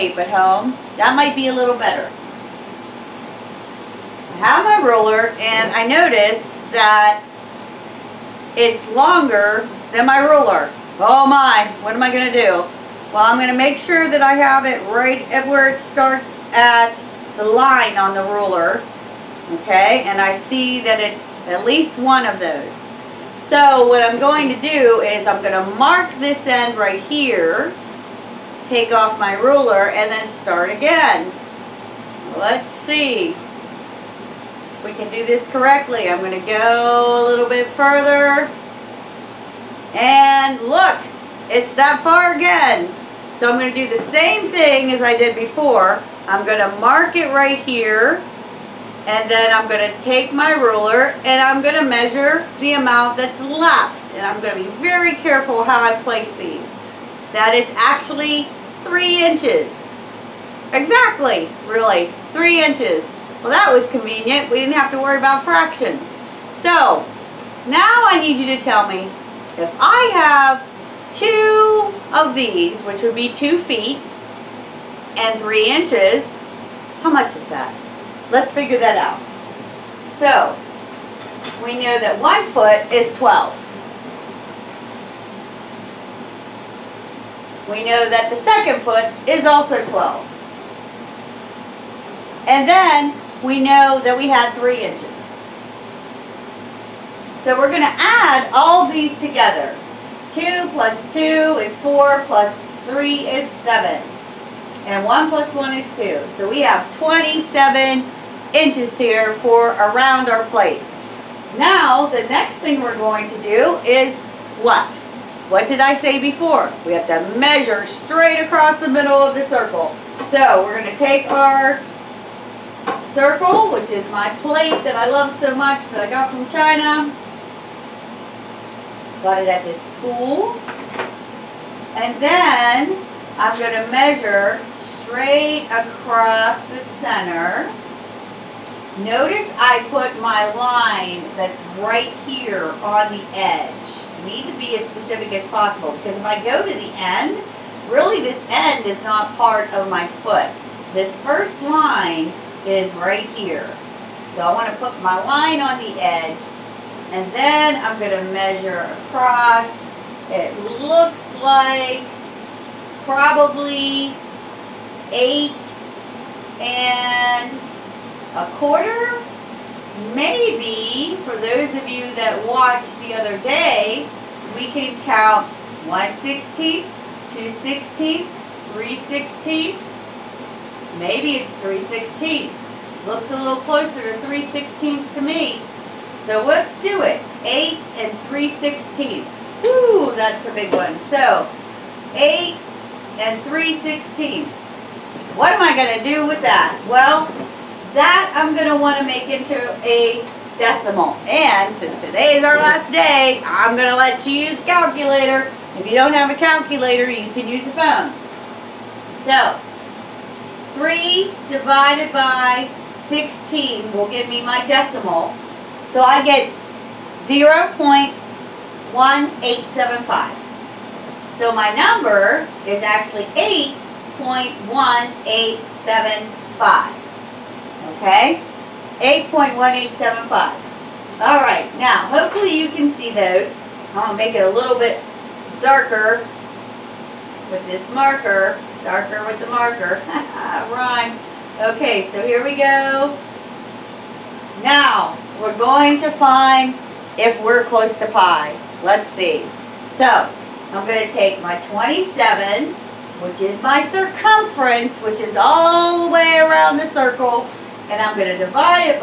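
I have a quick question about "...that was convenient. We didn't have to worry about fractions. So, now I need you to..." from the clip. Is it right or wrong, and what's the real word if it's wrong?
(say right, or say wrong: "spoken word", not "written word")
right.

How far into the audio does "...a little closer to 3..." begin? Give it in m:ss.
3:03.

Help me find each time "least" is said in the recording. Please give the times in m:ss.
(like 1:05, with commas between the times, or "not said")
0:21.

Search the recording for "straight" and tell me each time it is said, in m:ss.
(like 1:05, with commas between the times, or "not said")
1:57, 2:14.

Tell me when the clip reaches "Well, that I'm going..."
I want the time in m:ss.
3:16.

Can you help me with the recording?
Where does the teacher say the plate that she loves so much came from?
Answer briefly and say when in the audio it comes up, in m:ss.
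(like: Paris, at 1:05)
China, at 2:06.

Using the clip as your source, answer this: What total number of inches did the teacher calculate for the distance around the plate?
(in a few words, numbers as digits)
27.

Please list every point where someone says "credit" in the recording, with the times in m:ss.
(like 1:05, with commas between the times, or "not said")
not said.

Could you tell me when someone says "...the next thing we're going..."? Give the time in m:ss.
1:52.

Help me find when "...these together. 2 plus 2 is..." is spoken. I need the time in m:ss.
1:38.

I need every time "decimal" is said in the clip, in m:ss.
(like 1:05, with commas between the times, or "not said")
3:20, 3:34.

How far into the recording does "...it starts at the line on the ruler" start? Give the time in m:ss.
0:15.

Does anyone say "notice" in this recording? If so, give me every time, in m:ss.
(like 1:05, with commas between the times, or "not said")
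0:05, 2:19.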